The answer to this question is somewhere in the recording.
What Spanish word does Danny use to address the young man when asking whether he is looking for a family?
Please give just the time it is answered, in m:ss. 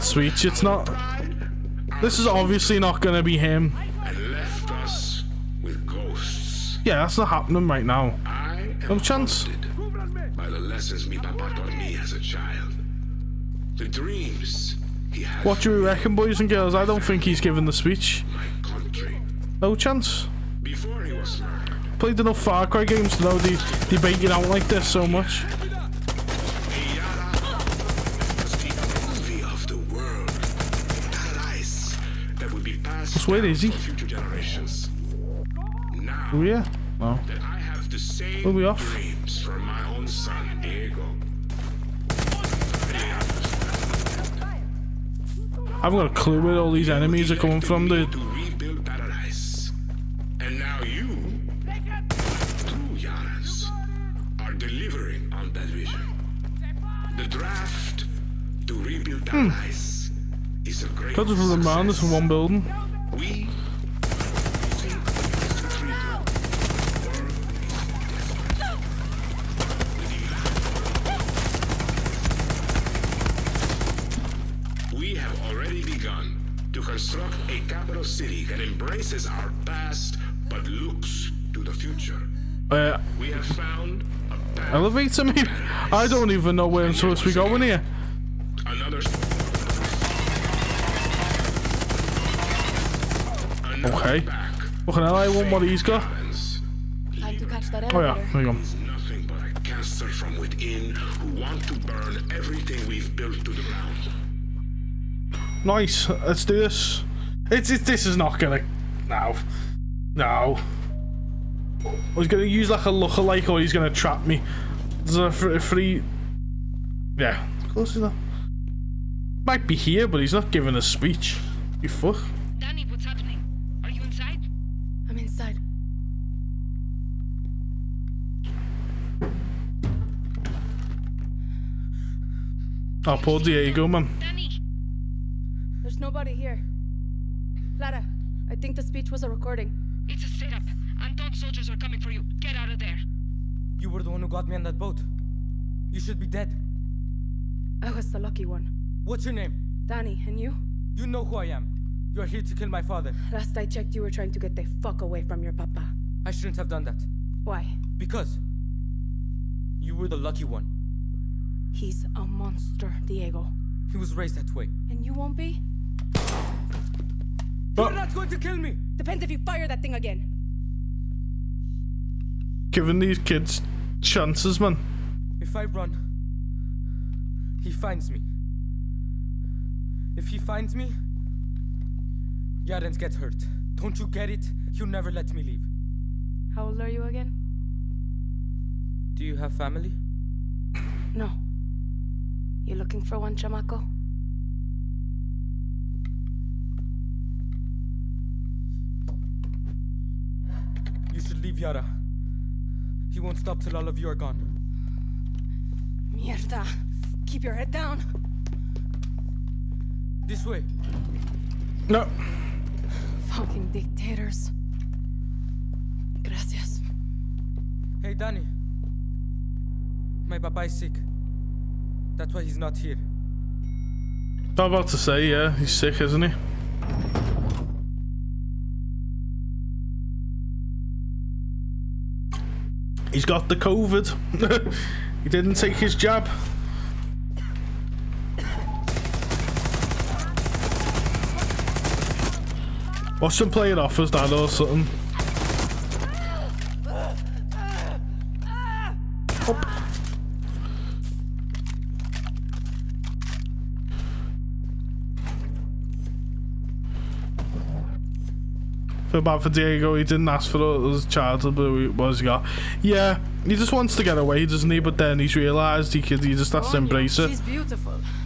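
3:13.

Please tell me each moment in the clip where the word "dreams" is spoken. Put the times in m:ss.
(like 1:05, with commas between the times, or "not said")
0:13, 0:38.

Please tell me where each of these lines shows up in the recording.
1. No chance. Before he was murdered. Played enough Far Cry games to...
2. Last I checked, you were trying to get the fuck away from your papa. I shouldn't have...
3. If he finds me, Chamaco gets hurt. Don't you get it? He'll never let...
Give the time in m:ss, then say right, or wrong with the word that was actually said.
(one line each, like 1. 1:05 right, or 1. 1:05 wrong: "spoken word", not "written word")
1. 0:19 right
2. 2:33 right
3. 3:00 wrong: "Yaren", not "Chamaco".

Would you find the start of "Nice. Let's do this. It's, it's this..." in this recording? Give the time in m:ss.
1:45.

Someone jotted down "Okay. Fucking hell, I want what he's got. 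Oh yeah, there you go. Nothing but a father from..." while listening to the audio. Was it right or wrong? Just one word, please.
wrong.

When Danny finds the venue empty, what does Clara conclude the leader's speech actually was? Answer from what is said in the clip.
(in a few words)
a recording.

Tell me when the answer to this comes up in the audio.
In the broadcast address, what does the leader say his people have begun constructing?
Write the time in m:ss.
1:17.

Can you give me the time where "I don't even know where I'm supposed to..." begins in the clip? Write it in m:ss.
1:25.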